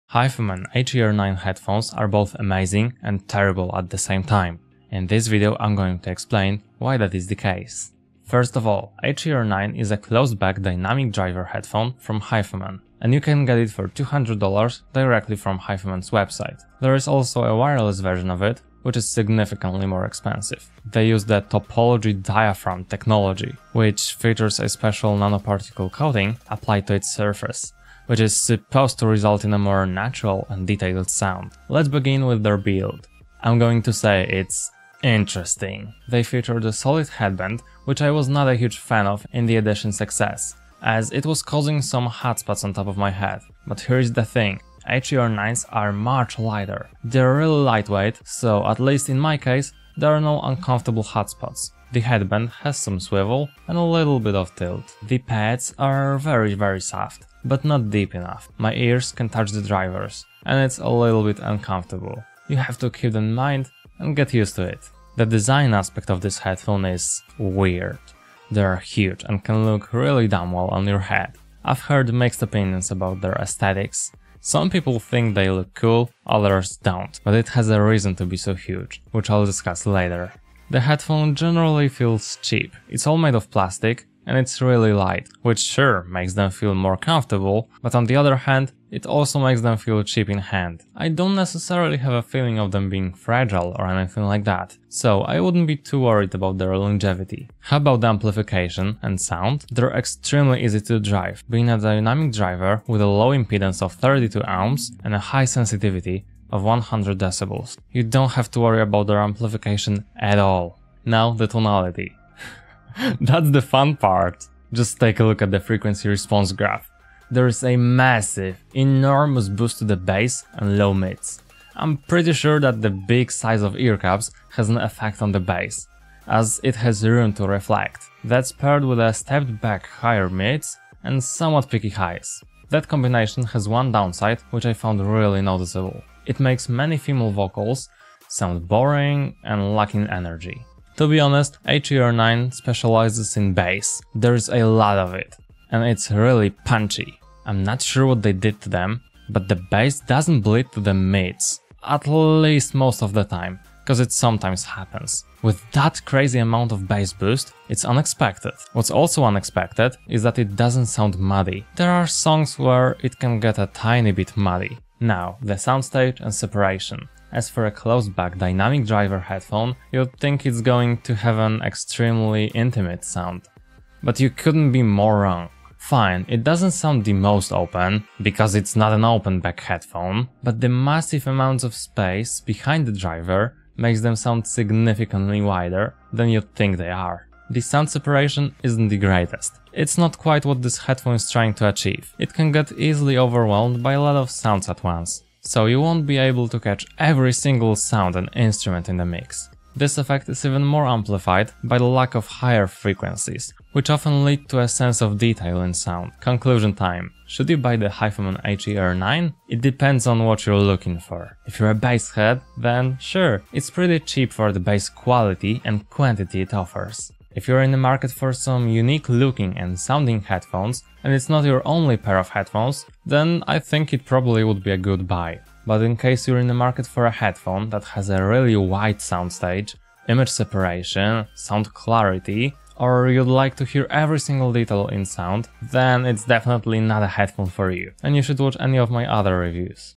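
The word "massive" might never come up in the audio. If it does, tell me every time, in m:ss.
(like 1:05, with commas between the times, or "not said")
1:57, 3:00.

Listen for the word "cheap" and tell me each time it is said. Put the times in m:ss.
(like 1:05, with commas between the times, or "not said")
1:22, 1:30, 3:34.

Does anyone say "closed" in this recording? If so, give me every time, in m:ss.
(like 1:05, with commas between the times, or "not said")
0:09, 2:47.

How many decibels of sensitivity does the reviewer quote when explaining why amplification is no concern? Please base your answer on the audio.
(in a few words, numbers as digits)
100 decibels.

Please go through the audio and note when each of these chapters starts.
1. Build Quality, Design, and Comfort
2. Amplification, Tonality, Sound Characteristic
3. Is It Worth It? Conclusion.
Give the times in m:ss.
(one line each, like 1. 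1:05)
1. 0:31
2. 1:37
3. 3:26.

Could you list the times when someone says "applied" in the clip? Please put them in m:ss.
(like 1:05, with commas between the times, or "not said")
0:26.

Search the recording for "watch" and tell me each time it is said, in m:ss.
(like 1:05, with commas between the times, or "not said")
3:58.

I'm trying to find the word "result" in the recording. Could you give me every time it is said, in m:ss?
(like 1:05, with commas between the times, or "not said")
0:29.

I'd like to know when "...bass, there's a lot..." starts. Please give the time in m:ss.
2:23.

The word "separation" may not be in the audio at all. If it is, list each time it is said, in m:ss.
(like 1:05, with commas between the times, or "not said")
2:46, 3:07, 3:50.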